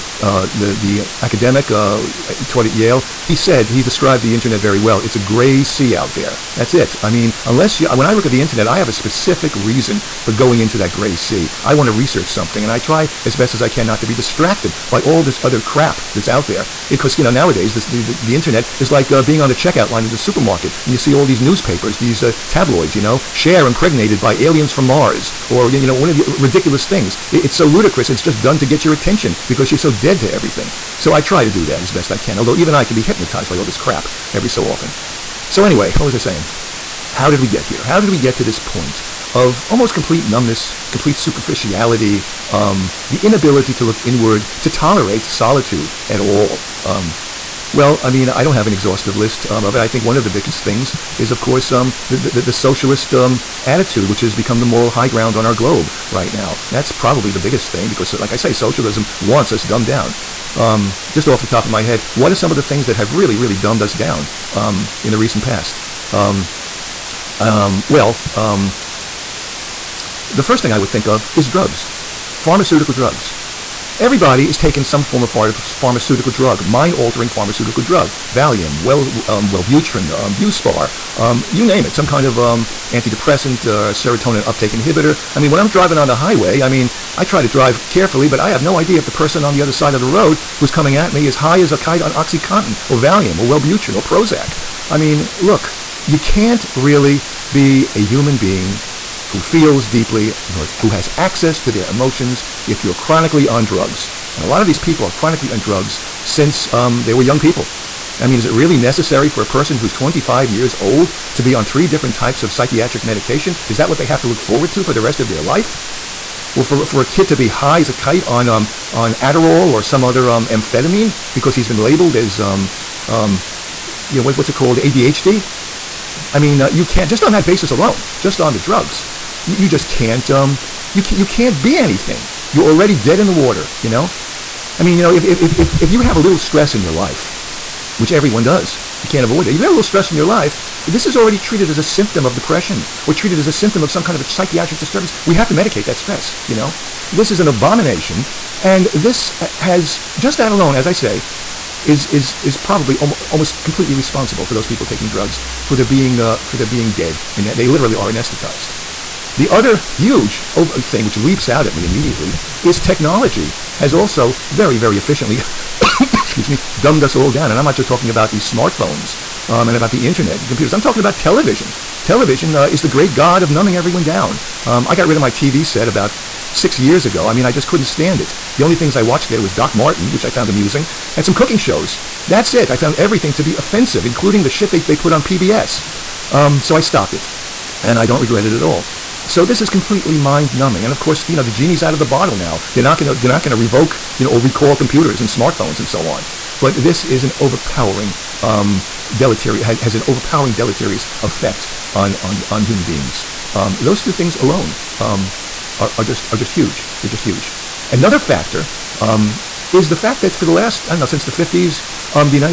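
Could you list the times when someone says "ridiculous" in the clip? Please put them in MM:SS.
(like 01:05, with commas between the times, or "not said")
00:26.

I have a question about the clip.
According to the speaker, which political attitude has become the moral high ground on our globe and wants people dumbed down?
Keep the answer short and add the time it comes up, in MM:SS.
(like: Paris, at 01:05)
socialist, at 00:52.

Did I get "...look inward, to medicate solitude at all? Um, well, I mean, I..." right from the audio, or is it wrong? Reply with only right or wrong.
wrong.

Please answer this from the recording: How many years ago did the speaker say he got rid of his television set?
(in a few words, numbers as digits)
6.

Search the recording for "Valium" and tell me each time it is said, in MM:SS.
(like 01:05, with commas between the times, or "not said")
01:18, 01:32.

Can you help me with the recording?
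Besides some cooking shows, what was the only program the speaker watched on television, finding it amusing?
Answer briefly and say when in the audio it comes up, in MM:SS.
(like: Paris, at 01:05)
Doc Martin, at 02:59.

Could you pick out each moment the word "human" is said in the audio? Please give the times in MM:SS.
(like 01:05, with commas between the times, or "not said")
01:38, 03:22.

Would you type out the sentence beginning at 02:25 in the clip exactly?
We have to medicate that stress, you know?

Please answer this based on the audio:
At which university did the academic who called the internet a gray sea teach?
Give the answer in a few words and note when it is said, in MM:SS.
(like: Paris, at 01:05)
Yale, at 00:02.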